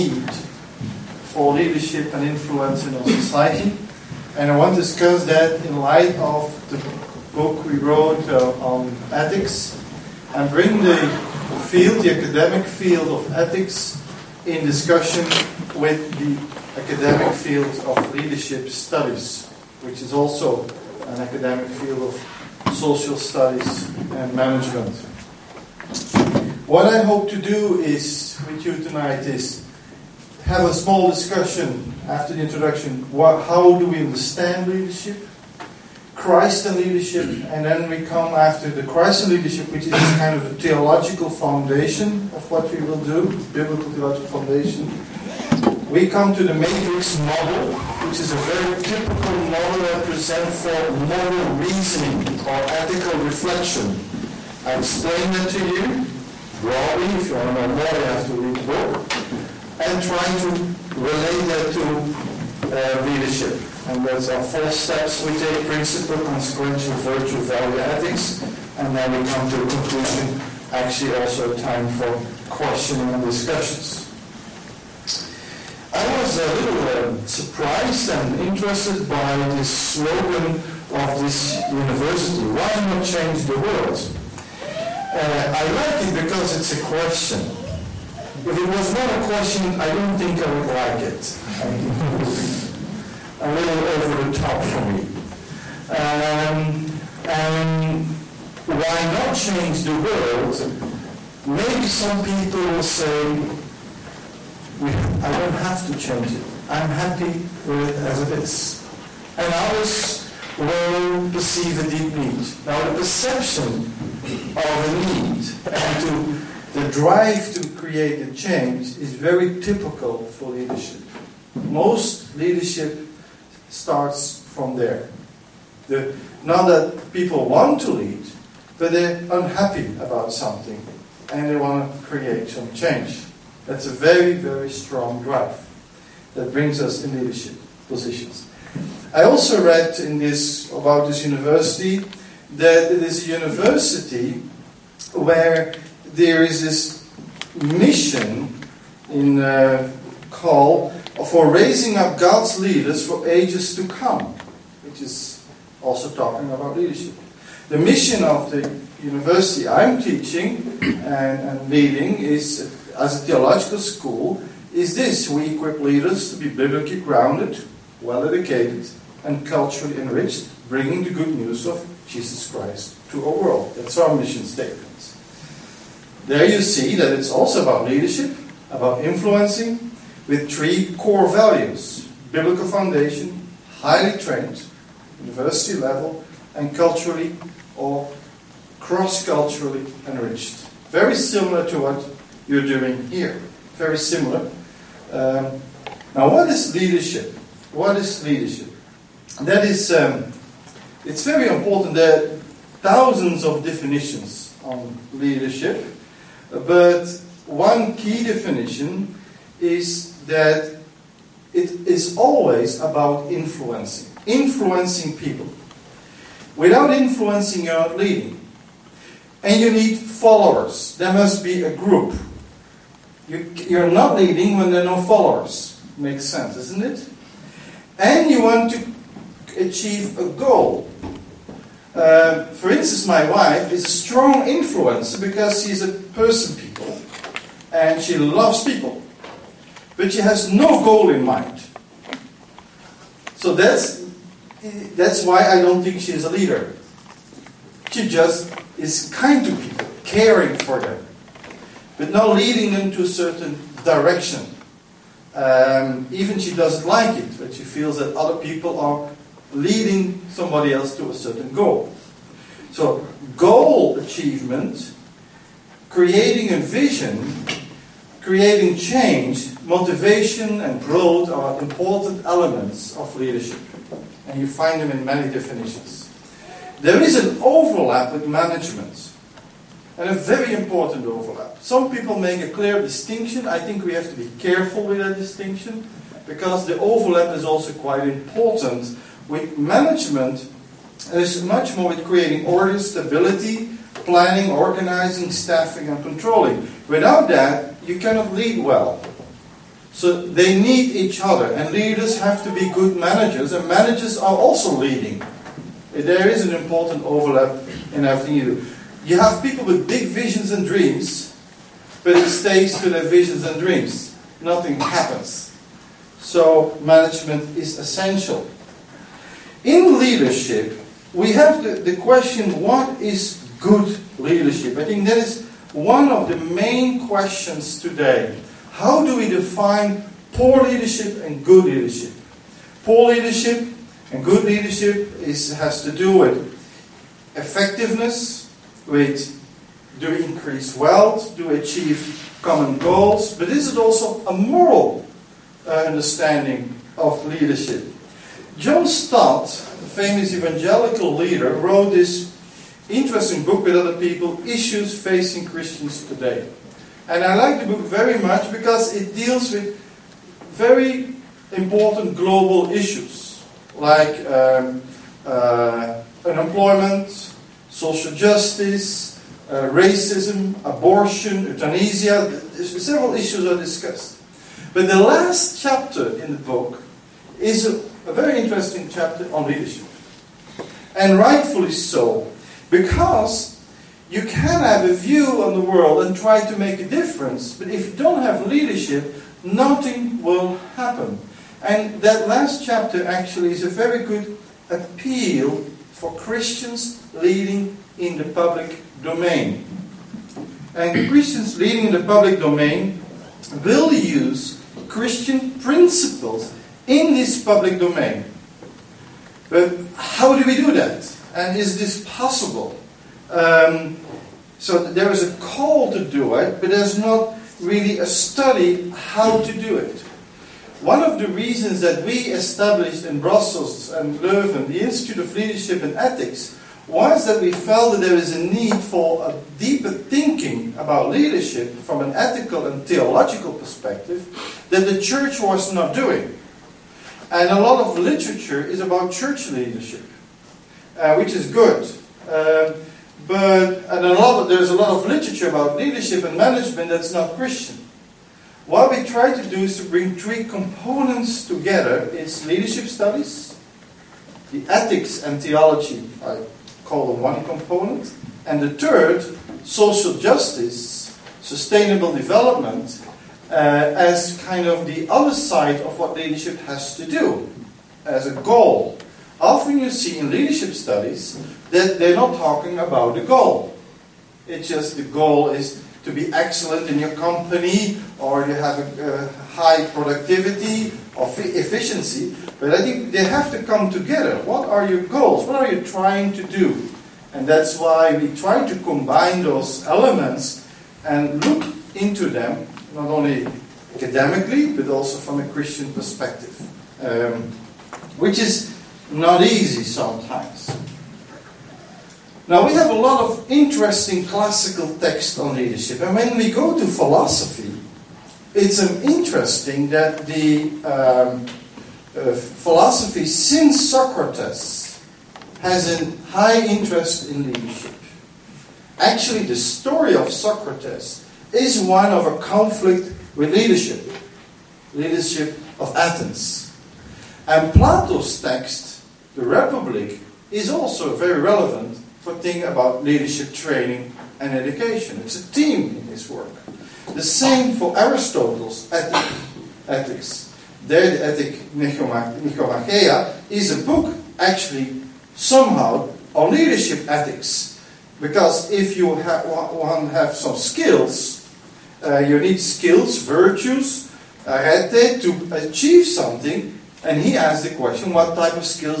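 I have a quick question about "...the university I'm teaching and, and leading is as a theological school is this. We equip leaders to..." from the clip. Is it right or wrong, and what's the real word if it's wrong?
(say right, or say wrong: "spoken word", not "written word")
right.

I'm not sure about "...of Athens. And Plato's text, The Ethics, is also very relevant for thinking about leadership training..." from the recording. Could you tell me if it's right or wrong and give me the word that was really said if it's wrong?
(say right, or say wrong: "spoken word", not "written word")
wrong: "Republic", not "Ethics".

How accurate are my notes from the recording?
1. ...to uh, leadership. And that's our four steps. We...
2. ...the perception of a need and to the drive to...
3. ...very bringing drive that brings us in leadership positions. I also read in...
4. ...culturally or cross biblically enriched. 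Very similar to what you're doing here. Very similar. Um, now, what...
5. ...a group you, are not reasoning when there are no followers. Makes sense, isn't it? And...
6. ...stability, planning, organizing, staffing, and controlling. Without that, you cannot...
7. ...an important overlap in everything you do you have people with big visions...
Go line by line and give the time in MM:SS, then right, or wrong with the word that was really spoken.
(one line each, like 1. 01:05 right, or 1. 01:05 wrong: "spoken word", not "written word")
1. 01:01 right
2. 01:52 right
3. 02:14 wrong: "strong", not "bringing"
4. 03:06 wrong: "culturally", not "biblically"
5. 03:41 wrong: "leading", not "reasoning"
6. 04:52 right
7. 05:06 right.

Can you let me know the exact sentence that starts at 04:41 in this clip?
Some people make a clear distinction.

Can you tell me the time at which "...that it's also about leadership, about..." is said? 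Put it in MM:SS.
02:56.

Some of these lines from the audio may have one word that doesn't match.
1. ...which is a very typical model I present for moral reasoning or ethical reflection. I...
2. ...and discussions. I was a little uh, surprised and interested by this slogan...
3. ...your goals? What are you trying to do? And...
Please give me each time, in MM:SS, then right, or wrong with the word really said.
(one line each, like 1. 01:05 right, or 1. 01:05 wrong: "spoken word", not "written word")
1. 00:48 right
2. 01:13 right
3. 08:04 right.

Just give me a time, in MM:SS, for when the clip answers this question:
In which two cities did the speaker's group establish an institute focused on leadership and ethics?
07:03.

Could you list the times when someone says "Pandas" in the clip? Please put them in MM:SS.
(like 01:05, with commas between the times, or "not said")
not said.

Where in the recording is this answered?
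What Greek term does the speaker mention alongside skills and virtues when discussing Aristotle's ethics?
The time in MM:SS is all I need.
09:14.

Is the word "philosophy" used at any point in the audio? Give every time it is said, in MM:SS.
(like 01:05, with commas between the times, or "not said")
08:26, 08:32.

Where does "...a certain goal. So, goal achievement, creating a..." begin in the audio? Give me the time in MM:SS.
04:21.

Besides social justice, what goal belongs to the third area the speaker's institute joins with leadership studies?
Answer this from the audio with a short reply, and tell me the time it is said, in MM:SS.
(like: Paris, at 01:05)
Sustainable development, at 07:41.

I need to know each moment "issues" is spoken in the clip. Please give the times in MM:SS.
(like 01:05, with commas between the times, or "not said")
05:54, 06:02, 06:13.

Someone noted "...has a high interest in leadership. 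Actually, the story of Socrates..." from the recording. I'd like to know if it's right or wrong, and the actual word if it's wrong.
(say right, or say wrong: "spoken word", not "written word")
right.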